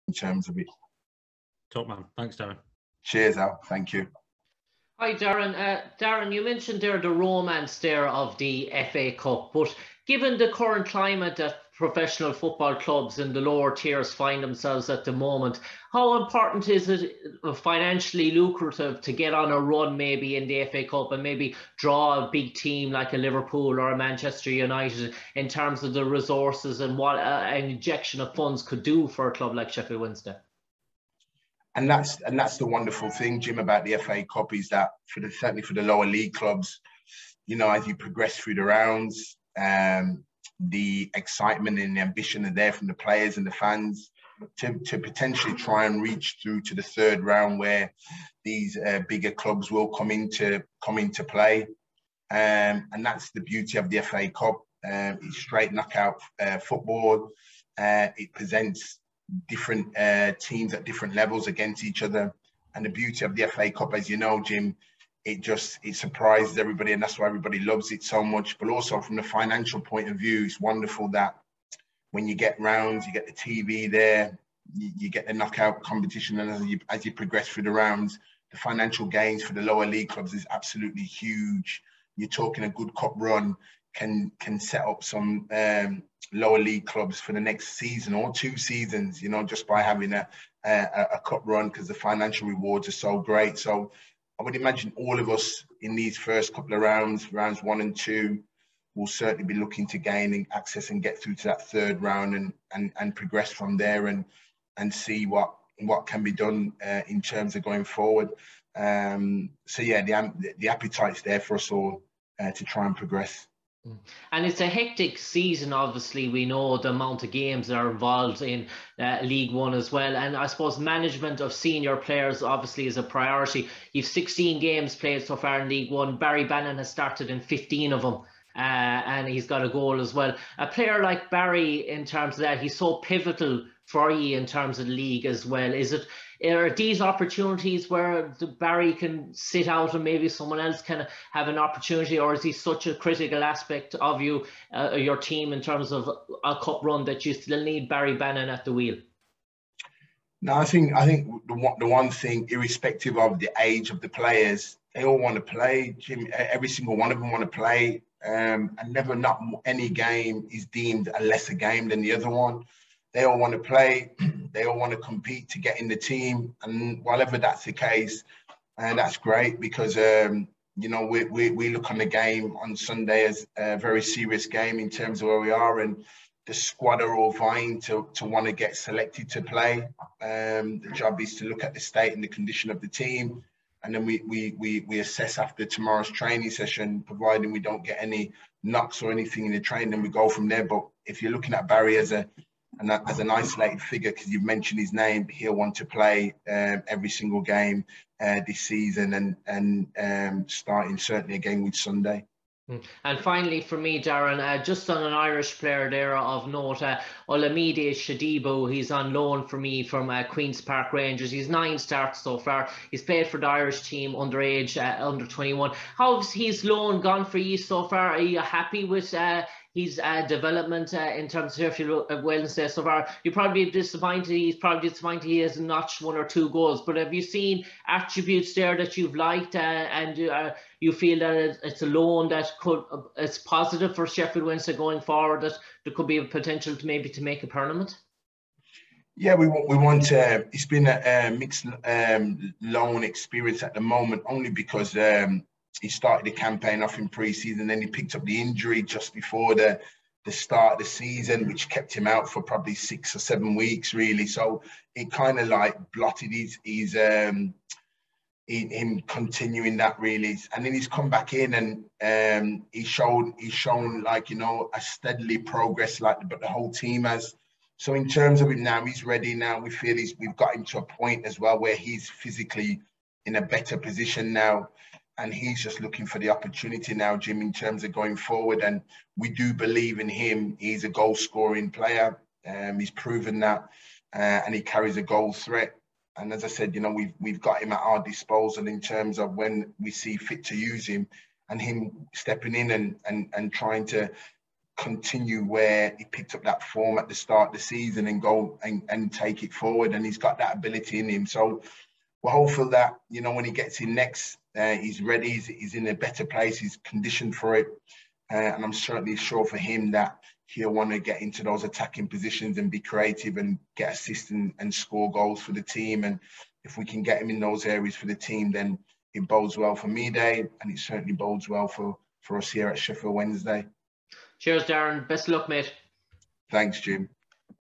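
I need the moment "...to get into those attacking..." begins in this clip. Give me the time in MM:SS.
05:10.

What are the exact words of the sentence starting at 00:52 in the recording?
Um, and that's the beauty of the FA Cup.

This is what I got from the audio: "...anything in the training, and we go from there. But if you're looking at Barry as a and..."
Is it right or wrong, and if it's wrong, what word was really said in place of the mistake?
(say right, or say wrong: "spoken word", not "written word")
right.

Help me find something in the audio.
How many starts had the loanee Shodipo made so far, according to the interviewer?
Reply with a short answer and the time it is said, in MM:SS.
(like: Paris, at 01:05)
9, at 03:31.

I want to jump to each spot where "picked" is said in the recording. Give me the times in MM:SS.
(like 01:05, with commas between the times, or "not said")
04:07, 04:56.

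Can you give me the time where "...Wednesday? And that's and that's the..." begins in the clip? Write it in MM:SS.
00:30.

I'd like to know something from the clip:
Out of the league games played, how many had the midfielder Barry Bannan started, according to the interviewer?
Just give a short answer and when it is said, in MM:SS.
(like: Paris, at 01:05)
15, at 02:07.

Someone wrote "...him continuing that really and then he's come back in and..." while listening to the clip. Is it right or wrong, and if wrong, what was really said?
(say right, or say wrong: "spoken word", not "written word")
right.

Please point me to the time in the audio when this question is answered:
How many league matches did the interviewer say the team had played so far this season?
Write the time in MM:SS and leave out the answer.
02:04.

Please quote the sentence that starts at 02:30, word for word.
No, I think I think the one, the one thing, irrespective of the age of the players, they all want to play.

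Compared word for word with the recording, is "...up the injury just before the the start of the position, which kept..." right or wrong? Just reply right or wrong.
wrong.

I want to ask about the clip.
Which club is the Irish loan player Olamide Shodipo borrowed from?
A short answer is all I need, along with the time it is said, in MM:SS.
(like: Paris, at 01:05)
Queen's Park Rangers, at 03:30.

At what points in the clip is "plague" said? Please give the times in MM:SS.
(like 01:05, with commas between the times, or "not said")
not said.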